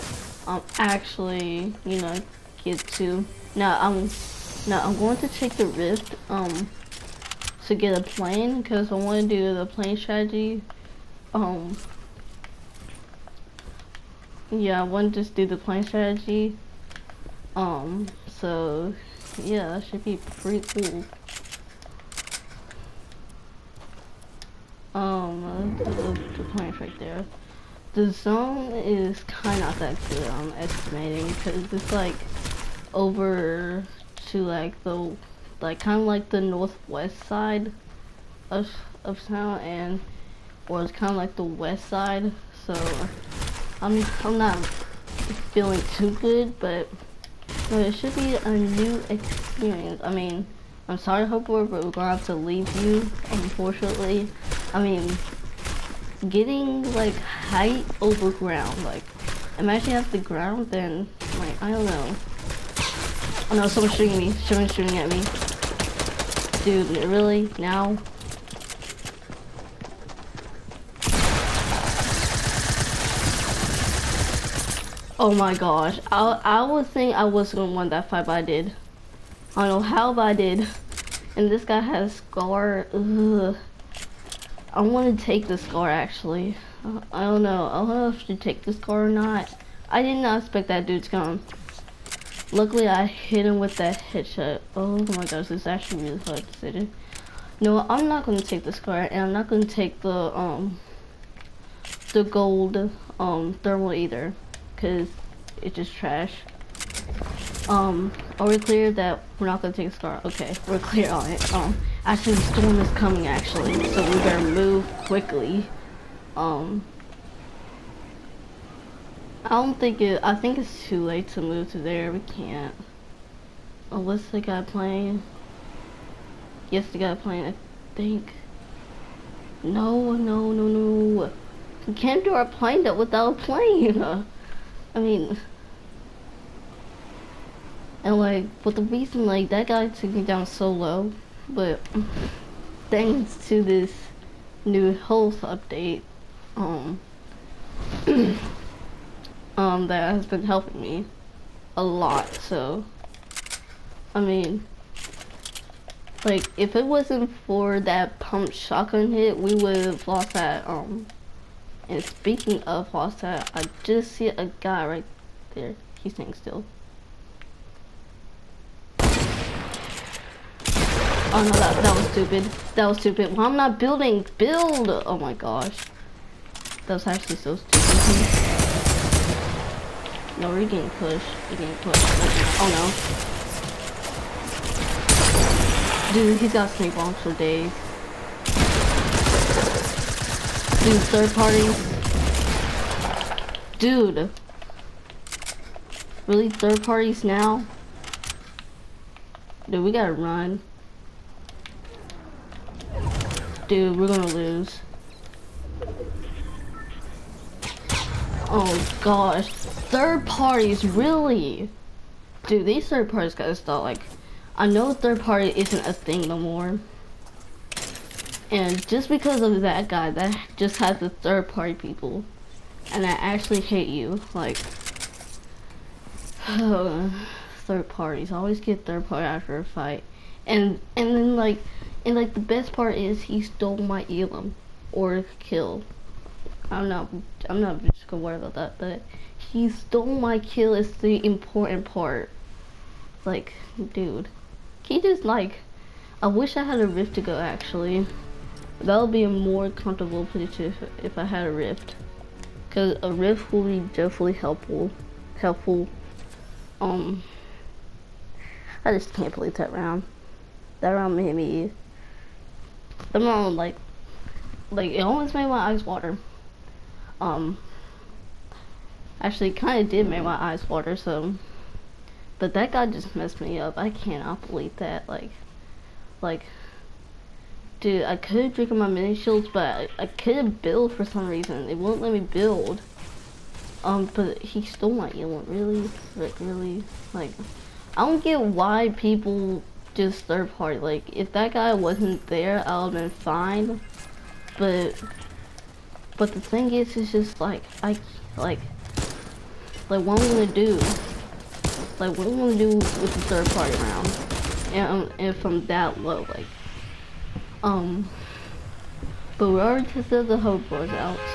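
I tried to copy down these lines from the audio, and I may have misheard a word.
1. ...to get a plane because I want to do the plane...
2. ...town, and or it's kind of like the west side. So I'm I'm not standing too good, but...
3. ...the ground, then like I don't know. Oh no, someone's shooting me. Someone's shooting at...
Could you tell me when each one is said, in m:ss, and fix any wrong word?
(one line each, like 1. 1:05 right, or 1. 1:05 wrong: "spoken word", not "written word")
1. 0:07 right
2. 0:39 wrong: "feeling", not "standing"
3. 1:00 right.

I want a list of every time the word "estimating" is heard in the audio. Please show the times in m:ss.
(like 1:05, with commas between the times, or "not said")
0:30.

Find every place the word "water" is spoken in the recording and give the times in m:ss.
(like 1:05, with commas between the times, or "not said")
4:25, 4:30.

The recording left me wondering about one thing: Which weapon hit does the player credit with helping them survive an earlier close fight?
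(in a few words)
pump shotgun.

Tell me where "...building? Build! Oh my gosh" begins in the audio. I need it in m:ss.
2:53.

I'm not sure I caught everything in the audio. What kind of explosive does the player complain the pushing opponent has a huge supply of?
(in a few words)
snake bombs.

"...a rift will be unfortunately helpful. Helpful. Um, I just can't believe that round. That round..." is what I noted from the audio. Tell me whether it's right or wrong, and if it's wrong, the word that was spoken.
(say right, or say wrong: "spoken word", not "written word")
wrong: "definitely", not "unfortunately".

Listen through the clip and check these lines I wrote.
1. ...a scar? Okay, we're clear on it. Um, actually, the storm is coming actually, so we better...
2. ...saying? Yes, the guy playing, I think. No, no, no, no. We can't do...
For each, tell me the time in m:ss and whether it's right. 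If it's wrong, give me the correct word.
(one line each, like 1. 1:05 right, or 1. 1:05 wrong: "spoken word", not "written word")
1. 1:49 right
2. 2:04 wrong: "playing", not "saying".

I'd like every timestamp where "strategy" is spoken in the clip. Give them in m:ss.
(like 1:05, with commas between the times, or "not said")
0:09, 0:15.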